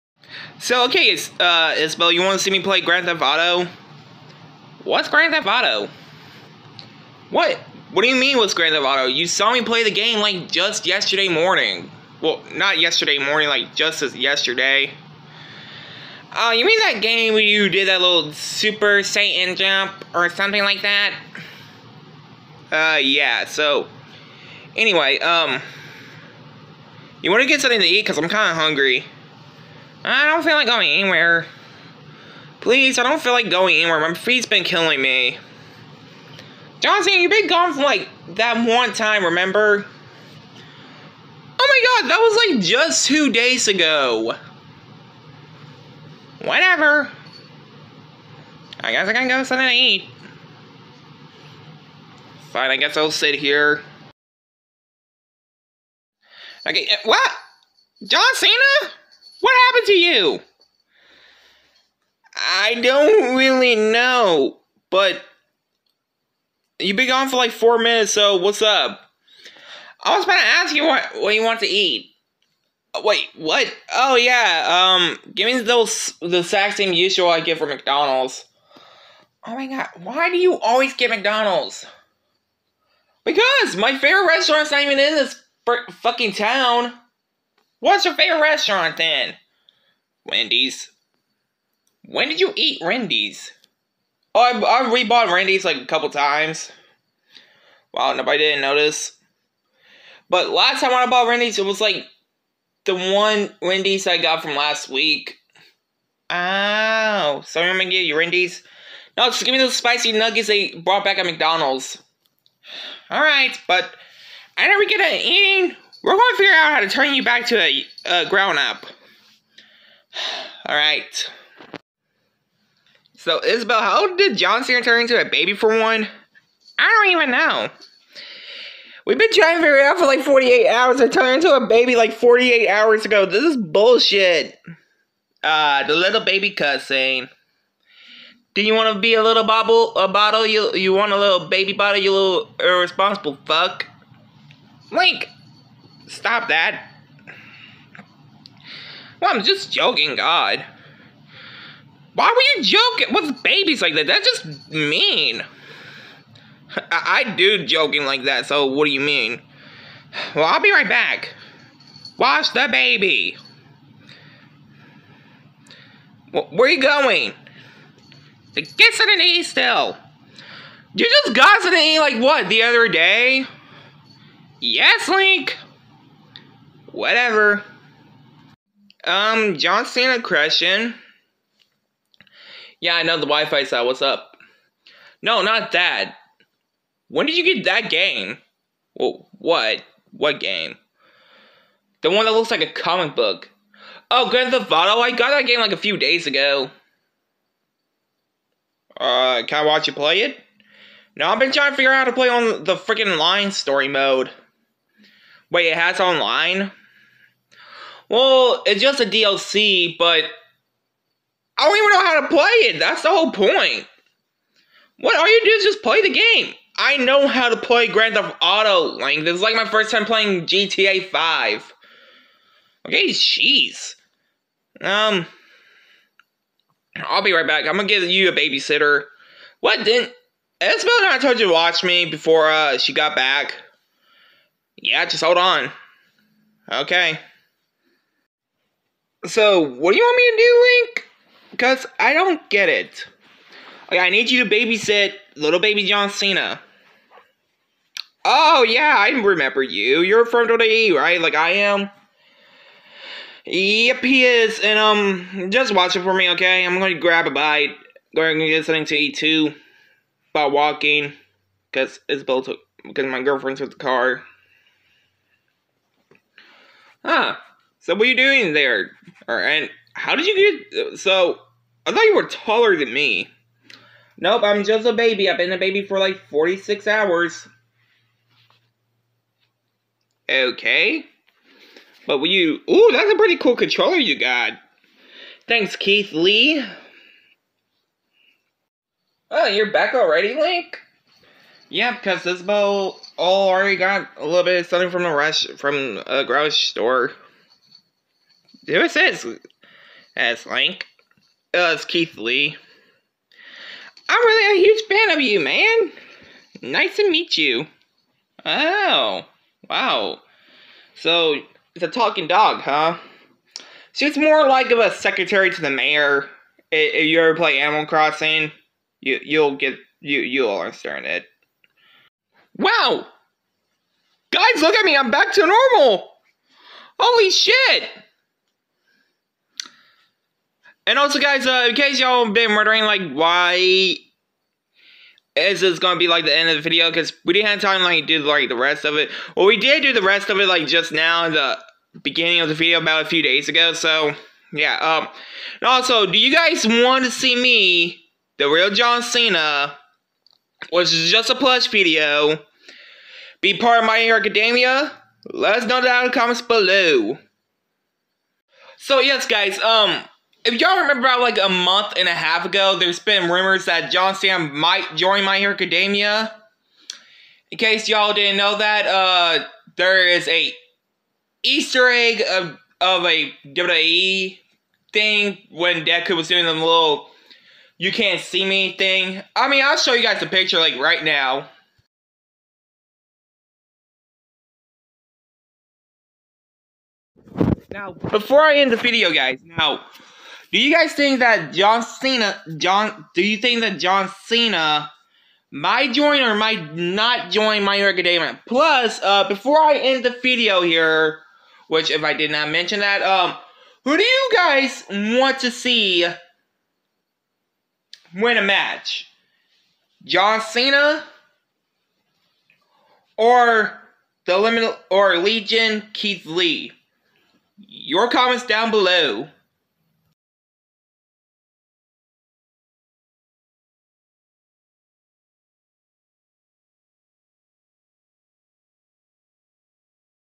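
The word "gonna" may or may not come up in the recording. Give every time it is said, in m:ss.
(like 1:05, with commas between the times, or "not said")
1:47, 3:47, 5:35.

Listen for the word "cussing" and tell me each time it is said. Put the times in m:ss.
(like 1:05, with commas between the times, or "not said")
2:16.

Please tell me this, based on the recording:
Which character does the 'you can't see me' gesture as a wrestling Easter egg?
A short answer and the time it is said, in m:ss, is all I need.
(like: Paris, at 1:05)
Deku, at 6:15.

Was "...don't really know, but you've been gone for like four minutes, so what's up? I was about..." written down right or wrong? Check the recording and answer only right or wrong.
right.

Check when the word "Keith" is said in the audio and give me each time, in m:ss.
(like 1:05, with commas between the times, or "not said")
4:45, 5:01, 6:55.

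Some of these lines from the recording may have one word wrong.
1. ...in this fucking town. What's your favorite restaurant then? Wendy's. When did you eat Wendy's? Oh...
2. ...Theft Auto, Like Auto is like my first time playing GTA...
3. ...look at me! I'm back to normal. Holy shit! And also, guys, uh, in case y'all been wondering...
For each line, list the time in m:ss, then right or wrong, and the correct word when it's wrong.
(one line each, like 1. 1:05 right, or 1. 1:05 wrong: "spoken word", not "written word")
1. 1:24 right
2. 3:38 wrong: "This", not "Auto"
3. 5:24 right.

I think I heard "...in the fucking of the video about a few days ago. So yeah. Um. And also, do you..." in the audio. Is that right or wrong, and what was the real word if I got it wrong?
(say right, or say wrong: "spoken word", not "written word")
wrong: "beginning", not "fucking".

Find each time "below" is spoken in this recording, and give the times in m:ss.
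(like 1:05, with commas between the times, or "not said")
5:56, 6:58.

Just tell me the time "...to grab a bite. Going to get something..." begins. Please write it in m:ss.
4:16.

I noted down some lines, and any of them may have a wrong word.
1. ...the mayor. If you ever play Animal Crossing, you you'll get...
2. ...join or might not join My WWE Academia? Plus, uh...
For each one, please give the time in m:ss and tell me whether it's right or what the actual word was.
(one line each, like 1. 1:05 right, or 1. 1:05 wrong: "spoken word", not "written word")
1. 5:15 right
2. 6:35 wrong: "Hero", not "WWE".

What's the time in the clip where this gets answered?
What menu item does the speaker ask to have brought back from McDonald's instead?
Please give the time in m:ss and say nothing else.
1:49.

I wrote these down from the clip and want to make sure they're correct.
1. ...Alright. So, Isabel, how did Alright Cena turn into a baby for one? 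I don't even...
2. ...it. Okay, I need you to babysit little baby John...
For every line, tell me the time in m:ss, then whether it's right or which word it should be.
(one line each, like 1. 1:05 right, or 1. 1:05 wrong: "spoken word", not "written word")
1. 2:00 wrong: "John", not "Alright"
2. 4:02 right.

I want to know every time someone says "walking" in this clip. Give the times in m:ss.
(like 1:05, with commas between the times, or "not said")
4:20.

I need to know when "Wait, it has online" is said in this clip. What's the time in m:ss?
3:25.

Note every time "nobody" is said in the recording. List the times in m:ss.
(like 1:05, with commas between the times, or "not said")
1:38.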